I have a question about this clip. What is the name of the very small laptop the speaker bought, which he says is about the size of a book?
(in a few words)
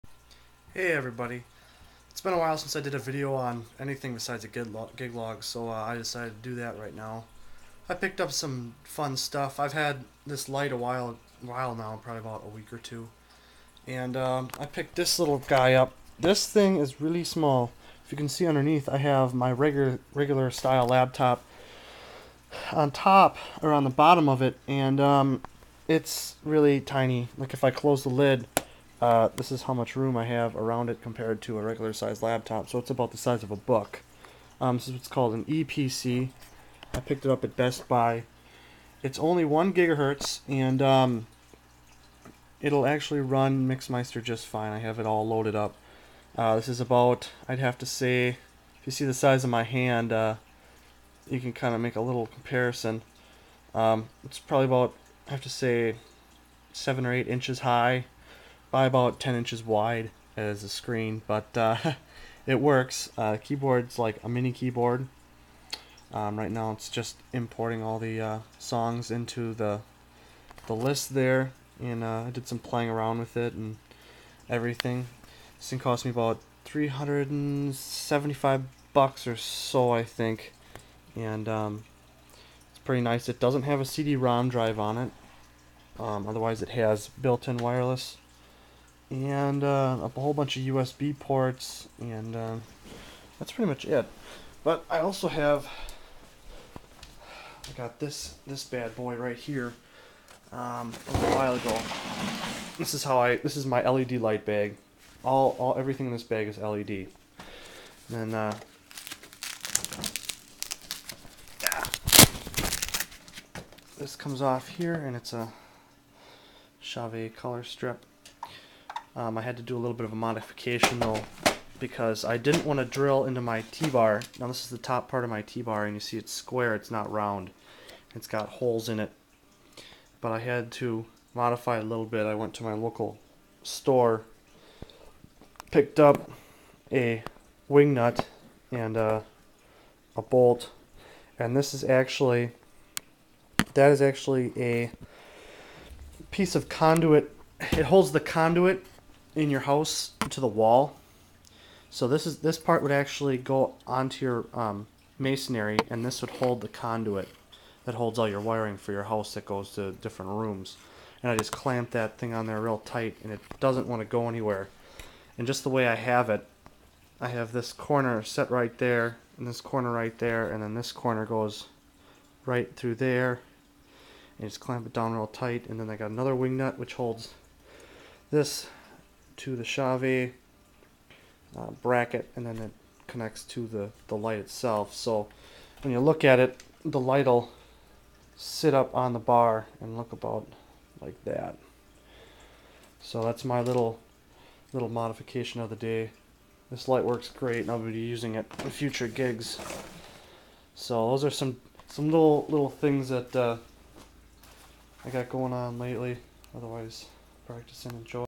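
Eee PC.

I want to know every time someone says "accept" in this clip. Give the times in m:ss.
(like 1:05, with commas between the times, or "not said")
not said.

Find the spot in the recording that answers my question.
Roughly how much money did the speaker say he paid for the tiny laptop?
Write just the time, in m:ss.
1:16.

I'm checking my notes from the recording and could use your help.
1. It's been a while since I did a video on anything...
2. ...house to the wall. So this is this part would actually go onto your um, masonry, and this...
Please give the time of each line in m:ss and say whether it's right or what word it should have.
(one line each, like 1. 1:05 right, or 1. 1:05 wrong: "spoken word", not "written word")
1. 0:02 right
2. 2:29 right.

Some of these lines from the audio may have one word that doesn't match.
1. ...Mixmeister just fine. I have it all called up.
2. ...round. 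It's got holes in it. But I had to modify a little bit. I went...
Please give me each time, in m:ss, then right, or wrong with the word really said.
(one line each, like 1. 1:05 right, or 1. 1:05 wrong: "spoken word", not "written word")
1. 0:43 wrong: "loaded", not "called"
2. 2:07 right.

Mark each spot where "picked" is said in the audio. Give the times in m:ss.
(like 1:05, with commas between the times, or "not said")
0:07, 0:14, 0:36, 2:15.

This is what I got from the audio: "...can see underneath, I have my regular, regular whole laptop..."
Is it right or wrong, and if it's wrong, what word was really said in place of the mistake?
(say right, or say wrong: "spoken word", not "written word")
wrong: "style", not "whole".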